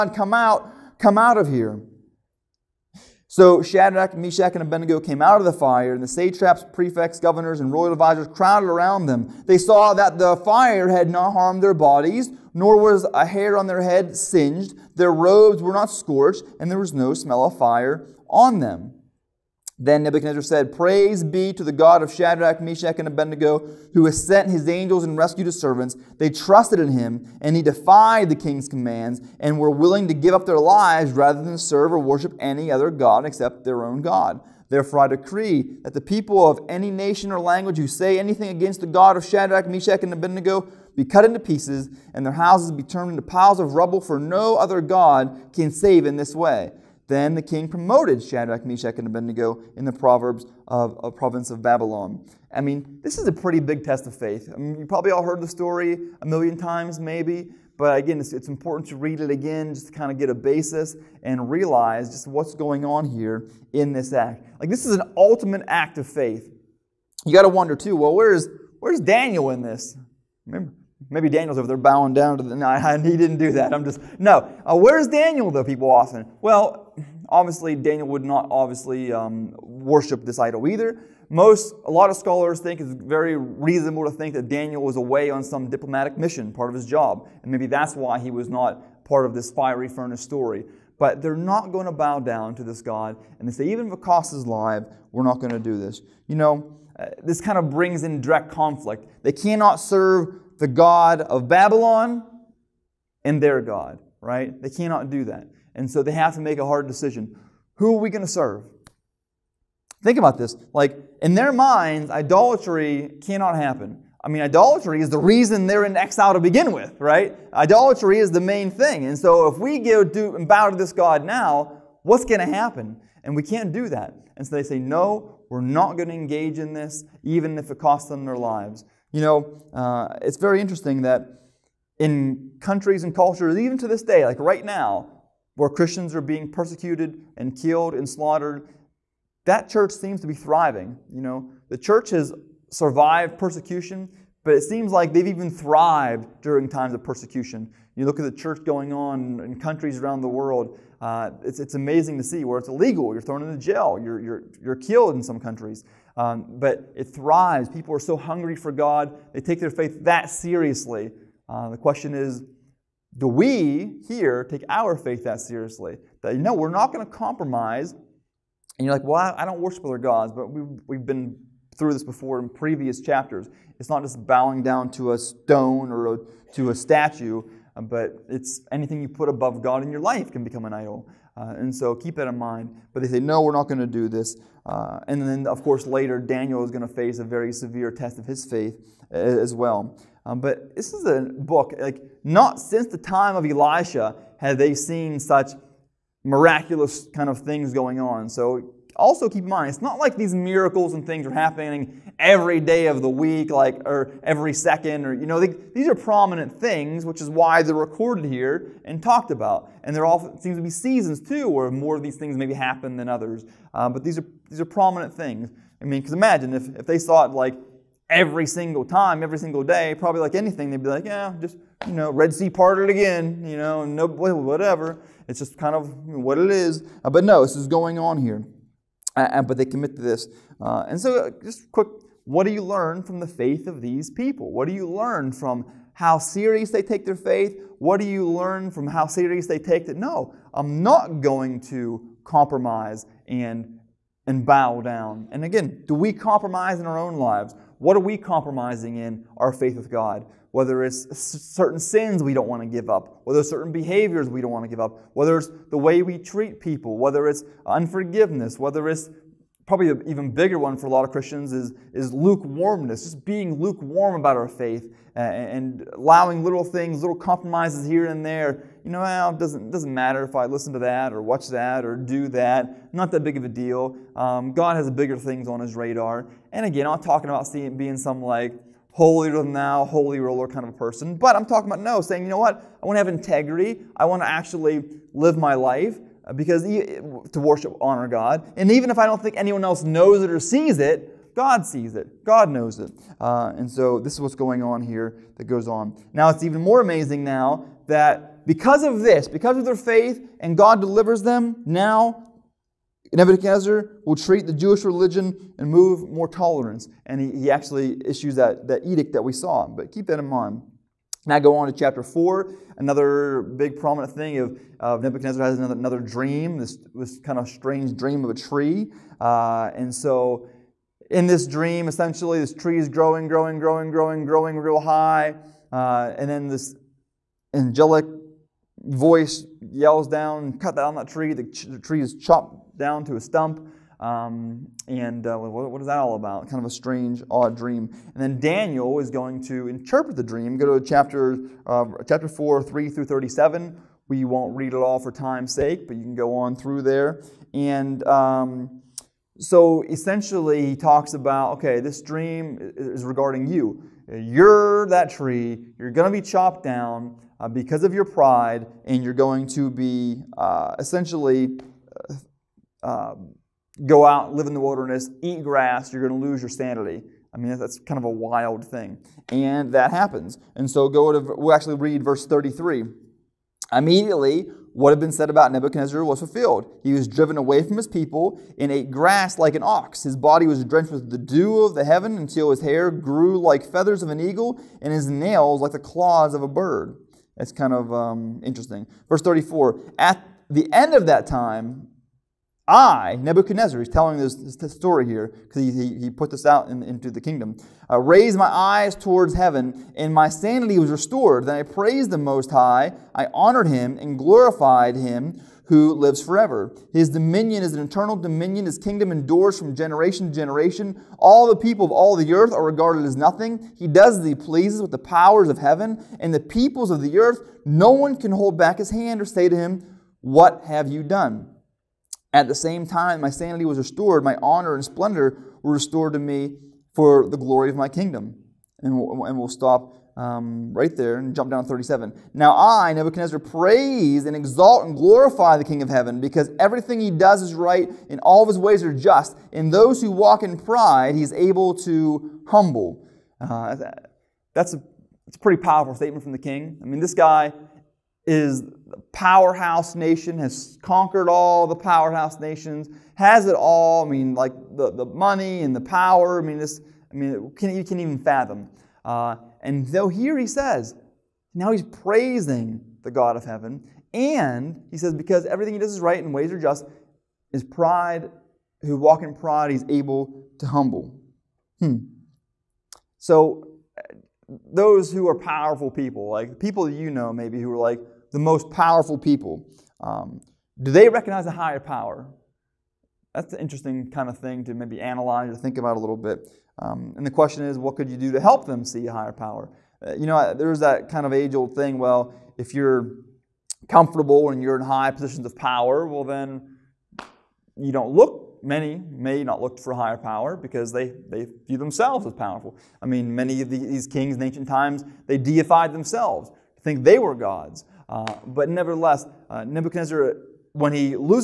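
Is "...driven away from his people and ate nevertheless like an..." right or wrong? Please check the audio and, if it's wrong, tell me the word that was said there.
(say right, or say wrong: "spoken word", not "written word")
wrong: "grass", not "nevertheless".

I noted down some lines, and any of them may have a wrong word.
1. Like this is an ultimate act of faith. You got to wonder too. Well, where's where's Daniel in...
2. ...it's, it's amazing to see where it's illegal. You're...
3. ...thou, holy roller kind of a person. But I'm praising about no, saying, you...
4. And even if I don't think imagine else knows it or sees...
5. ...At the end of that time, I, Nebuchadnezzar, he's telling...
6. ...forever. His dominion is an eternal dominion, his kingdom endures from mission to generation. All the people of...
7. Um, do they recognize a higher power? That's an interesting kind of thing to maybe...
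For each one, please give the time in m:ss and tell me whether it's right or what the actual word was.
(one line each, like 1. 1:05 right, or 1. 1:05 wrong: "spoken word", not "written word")
1. 1:04 right
2. 2:31 right
3. 4:39 wrong: "talking", not "praising"
4. 4:48 wrong: "anyone", not "imagine"
5. 6:29 right
6. 6:46 wrong: "generation", not "mission"
7. 8:00 right.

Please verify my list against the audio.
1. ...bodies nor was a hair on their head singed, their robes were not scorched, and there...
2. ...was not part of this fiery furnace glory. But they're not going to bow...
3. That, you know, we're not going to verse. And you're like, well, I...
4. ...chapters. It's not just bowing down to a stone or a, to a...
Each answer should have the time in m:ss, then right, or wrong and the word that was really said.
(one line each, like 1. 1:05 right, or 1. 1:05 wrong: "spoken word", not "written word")
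1. 0:11 right
2. 1:28 wrong: "story", not "glory"
3. 2:46 wrong: "compromise", not "verse"
4. 2:53 right.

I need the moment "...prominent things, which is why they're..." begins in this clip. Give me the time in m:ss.
3:25.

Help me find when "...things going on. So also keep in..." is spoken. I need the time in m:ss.
3:17.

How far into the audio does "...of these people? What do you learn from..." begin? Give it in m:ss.
3:53.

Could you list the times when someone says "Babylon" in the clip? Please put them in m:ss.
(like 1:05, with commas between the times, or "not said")
0:51, 1:41.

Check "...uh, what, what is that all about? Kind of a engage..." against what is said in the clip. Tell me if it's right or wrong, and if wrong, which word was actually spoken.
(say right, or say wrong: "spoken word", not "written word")
wrong: "strange", not "engage".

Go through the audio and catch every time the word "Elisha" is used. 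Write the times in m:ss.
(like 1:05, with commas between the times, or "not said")
3:13.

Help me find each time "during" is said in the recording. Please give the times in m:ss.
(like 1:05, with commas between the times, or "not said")
2:26.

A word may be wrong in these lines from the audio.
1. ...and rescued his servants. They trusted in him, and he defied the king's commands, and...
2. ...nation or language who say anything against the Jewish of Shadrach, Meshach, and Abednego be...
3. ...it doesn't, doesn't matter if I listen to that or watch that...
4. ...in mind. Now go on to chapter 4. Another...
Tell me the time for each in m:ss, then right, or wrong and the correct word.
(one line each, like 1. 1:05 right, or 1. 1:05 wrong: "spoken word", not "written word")
1. 0:25 right
2. 0:36 wrong: "God", not "Jewish"
3. 4:29 right
4. 5:10 right.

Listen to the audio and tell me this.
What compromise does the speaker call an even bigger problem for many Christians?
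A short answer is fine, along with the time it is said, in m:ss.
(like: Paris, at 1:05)
Lukewarmness, at 4:22.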